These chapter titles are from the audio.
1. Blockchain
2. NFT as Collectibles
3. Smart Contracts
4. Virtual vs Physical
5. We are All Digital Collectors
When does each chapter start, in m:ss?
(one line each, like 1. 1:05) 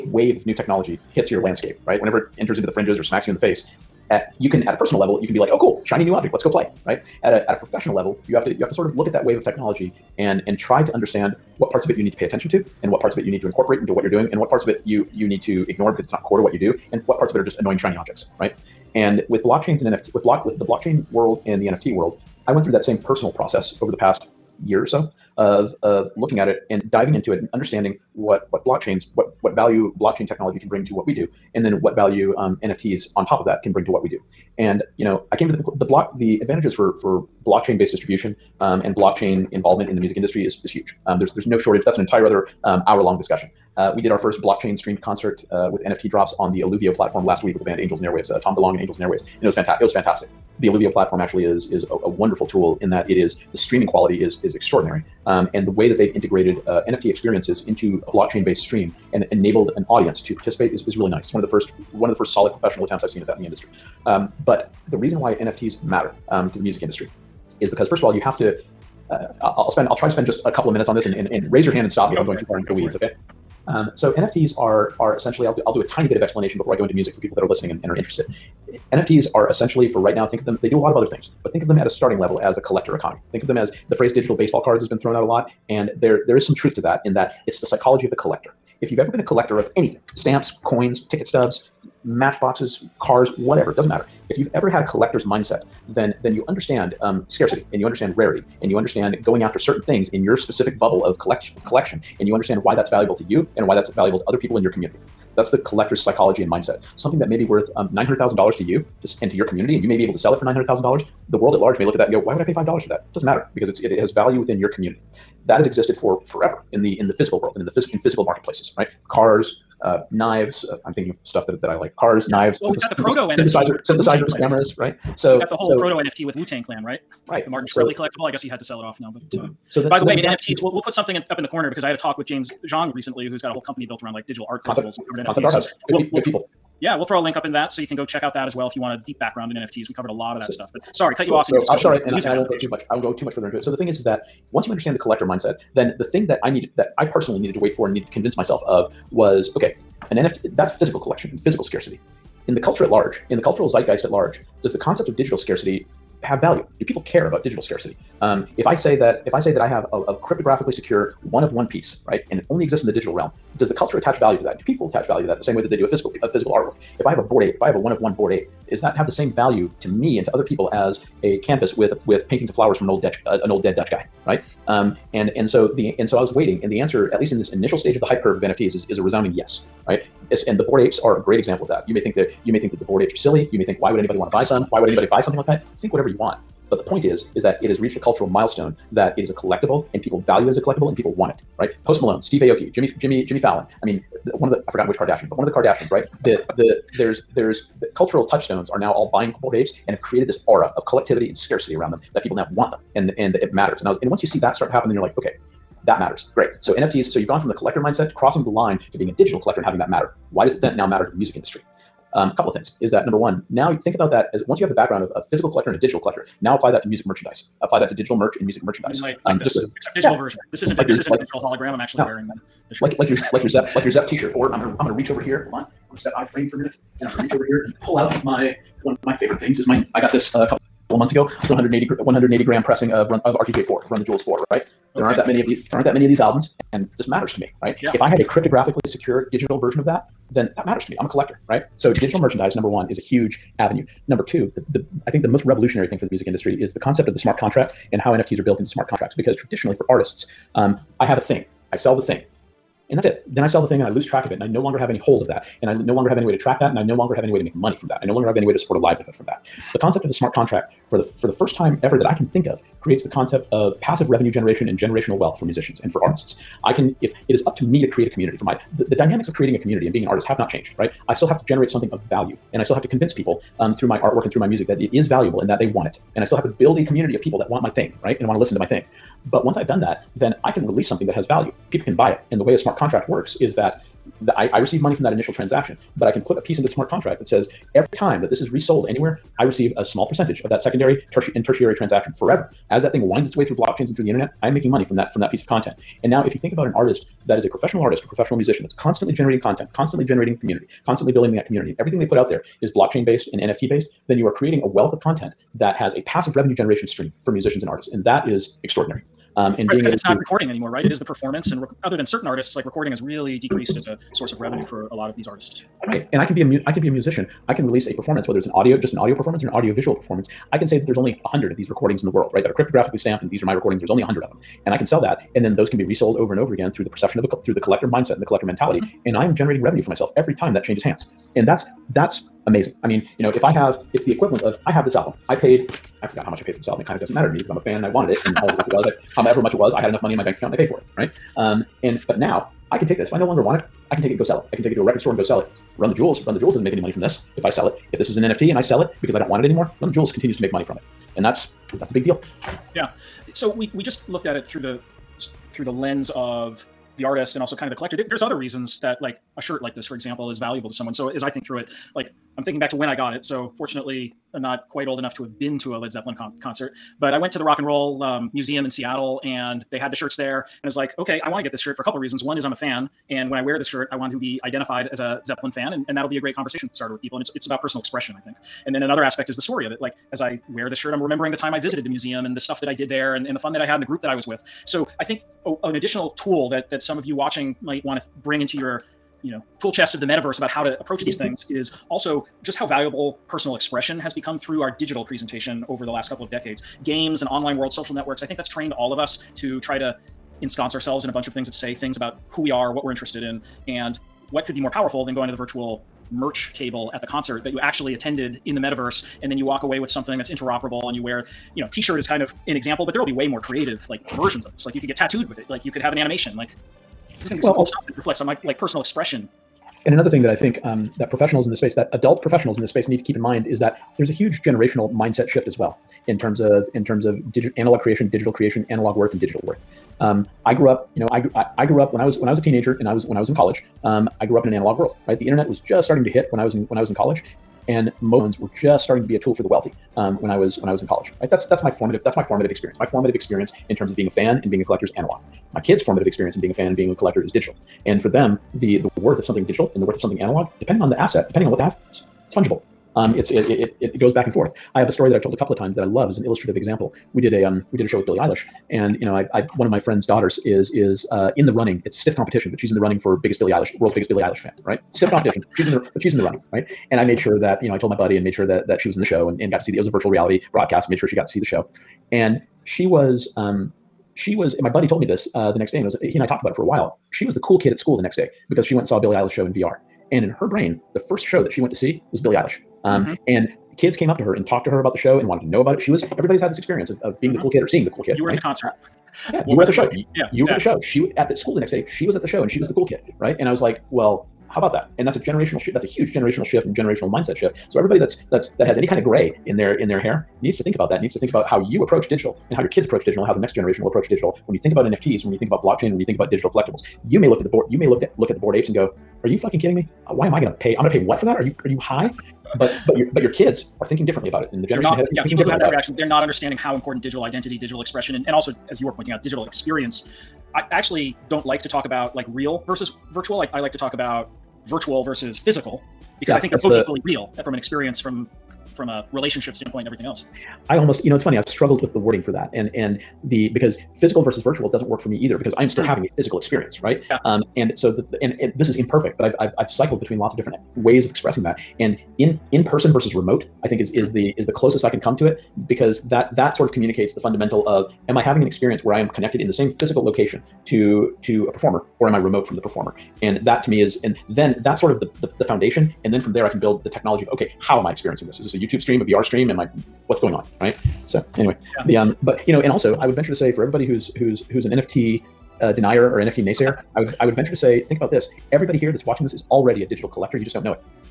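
1. 0:16
2. 1:18
3. 4:01
4. 8:39
5. 9:21.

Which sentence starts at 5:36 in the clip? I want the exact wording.
It kind of doesn't matter to me because I'm a fan and I wanted it.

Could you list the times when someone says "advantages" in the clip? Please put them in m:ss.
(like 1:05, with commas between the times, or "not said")
0:36.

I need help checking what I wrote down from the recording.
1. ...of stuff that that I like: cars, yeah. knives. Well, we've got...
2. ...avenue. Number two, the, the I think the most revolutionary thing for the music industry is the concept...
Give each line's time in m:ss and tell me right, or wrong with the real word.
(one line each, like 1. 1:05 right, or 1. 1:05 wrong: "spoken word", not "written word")
1. 2:01 right
2. 4:03 right.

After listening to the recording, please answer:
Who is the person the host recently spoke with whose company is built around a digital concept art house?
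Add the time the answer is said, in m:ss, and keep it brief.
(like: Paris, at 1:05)
James Zhang, at 2:12.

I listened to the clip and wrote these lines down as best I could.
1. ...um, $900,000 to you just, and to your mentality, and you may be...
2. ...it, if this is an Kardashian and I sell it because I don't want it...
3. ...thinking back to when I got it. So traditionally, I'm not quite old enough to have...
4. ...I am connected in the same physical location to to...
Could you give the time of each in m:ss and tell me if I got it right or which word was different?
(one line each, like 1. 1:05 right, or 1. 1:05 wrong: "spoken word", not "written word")
1. 1:47 wrong: "community", not "mentality"
2. 5:47 wrong: "NFT", not "Kardashian"
3. 6:02 wrong: "fortunately", not "traditionally"
4. 9:08 right.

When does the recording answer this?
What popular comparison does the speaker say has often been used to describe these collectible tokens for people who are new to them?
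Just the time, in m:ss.
1:24.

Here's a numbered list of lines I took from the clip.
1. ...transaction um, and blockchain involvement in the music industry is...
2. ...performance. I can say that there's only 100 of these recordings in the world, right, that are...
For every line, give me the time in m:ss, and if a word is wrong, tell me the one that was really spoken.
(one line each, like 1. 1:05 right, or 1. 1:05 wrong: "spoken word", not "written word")
1. 0:37 wrong: "distribution", not "transaction"
2. 5:19 right.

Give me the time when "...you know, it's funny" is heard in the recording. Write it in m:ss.
8:51.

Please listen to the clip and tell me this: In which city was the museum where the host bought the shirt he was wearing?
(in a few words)
Seattle.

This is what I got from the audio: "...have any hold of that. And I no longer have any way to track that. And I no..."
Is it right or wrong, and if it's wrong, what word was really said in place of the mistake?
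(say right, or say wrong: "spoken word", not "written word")
right.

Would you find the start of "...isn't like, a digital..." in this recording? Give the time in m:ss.
3:40.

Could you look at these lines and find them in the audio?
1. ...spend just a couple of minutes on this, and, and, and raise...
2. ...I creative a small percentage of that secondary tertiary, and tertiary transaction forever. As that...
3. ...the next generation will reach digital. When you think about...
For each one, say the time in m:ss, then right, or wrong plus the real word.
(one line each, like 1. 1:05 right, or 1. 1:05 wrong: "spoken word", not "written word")
1. 1:10 right
2. 4:49 wrong: "receive", not "creative"
3. 8:23 wrong: "approach", not "reach".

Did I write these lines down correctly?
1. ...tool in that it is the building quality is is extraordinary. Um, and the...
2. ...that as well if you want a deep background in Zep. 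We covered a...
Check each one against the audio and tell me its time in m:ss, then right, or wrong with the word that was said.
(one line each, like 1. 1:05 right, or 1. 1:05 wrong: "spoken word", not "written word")
1. 0:52 wrong: "streaming", not "building"
2. 2:18 wrong: "NFTs", not "Zep".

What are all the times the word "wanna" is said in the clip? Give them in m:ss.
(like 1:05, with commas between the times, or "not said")
not said.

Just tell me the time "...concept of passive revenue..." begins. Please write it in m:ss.
4:23.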